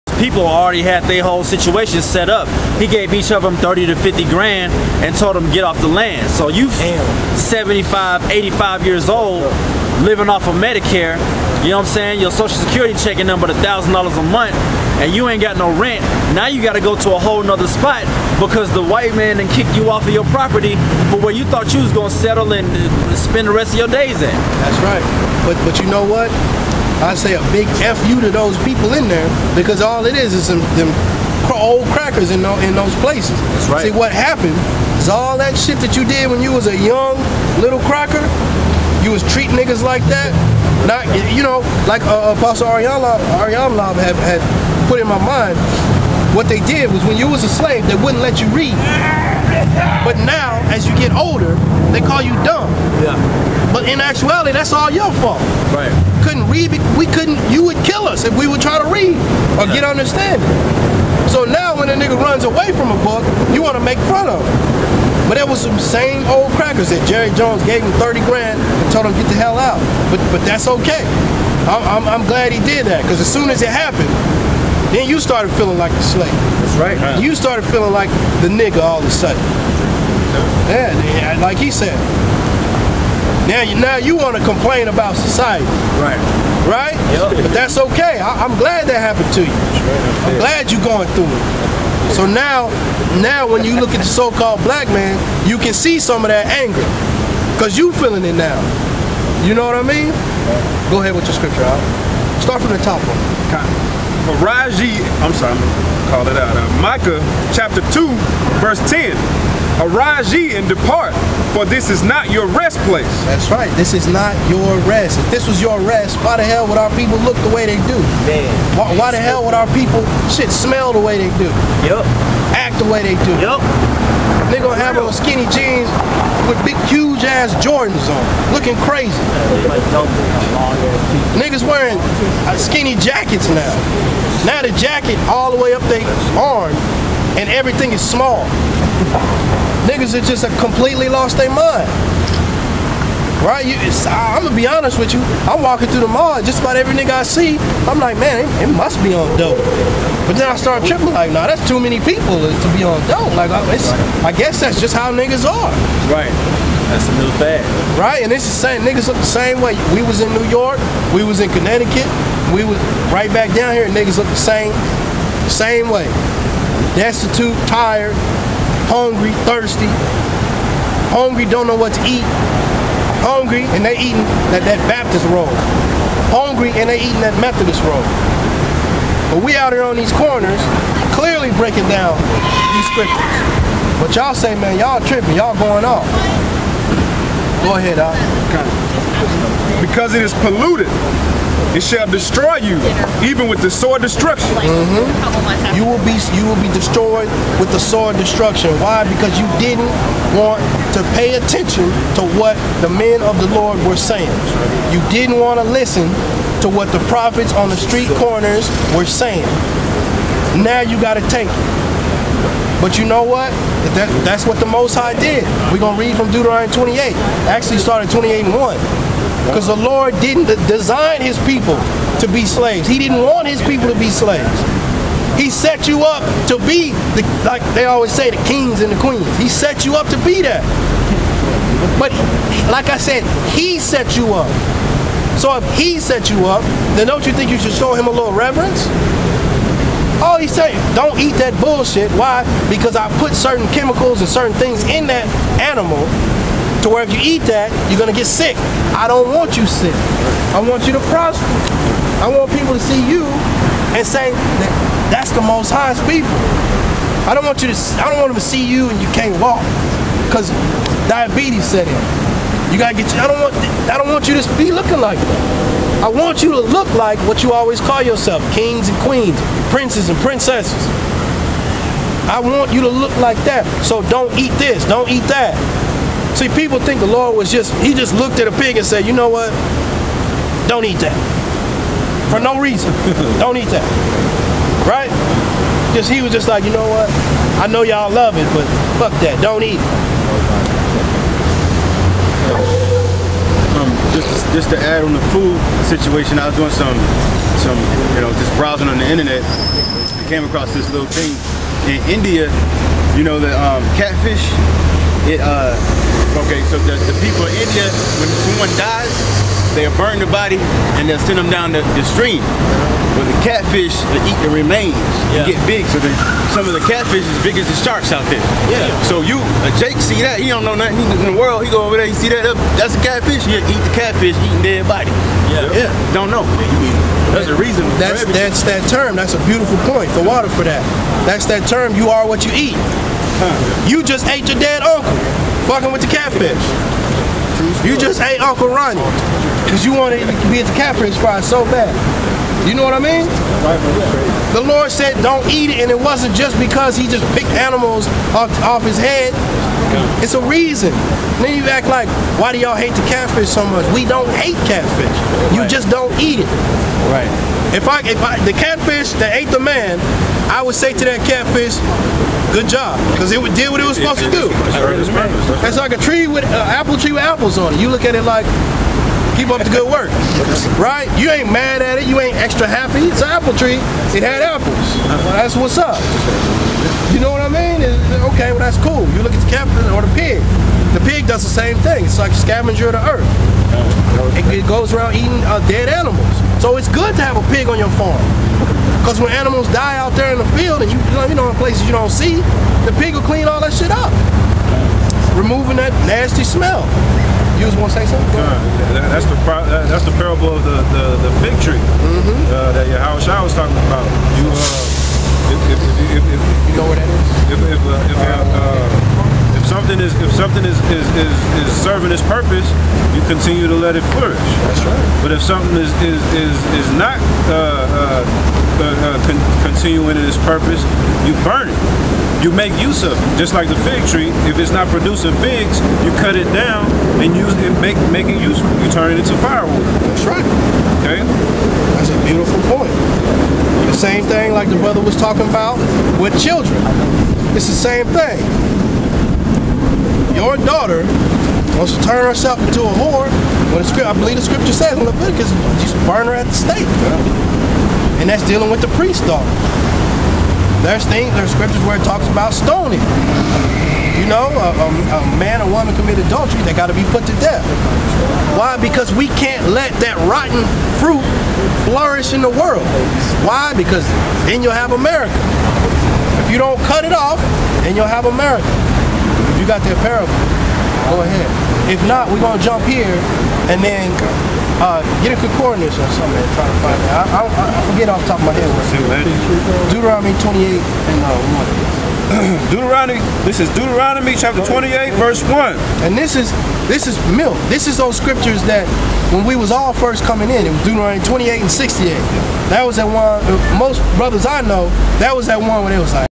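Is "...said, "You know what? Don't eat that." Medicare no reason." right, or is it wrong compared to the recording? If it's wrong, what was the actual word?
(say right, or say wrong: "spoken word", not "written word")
wrong: "For", not "Medicare".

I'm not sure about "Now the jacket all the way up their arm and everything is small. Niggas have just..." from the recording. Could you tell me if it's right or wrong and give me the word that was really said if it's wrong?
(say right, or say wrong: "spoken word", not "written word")
right.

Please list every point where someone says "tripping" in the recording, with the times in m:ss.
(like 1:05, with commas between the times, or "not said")
2:30, 3:05.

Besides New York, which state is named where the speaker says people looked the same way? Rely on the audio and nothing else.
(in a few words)
Connecticut.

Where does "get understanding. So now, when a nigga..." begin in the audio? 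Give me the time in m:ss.
0:59.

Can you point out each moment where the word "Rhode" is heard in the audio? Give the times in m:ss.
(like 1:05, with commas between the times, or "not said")
not said.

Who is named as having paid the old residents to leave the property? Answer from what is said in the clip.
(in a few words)
Jerry Jones.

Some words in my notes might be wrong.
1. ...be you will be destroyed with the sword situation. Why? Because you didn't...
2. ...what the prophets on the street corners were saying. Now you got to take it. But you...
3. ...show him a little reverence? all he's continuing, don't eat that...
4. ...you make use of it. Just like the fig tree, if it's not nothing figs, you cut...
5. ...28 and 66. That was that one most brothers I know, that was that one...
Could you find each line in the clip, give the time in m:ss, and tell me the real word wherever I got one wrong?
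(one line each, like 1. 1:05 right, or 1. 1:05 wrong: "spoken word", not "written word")
1. 3:16 wrong: "destruction", not "situation"
2. 3:26 right
3. 3:57 wrong: "saying", not "continuing"
4. 7:02 wrong: "producing", not "nothing"
5. 8:11 wrong: "68", not "66".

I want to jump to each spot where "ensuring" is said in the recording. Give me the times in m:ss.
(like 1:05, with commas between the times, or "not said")
not said.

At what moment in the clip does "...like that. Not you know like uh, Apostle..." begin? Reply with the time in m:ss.
0:39.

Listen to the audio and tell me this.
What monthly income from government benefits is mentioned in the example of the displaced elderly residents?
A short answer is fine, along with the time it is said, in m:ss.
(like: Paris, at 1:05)
$1,000 a month, at 0:13.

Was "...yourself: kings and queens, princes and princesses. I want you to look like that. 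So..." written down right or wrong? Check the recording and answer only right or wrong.
right.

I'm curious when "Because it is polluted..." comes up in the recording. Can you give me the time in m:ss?
3:09.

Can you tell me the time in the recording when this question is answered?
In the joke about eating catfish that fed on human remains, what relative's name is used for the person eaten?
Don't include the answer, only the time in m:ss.
5:38.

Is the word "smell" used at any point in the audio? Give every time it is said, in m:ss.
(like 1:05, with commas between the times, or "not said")
2:00, 6:36.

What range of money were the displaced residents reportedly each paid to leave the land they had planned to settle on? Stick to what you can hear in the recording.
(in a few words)
30 to 50 grand.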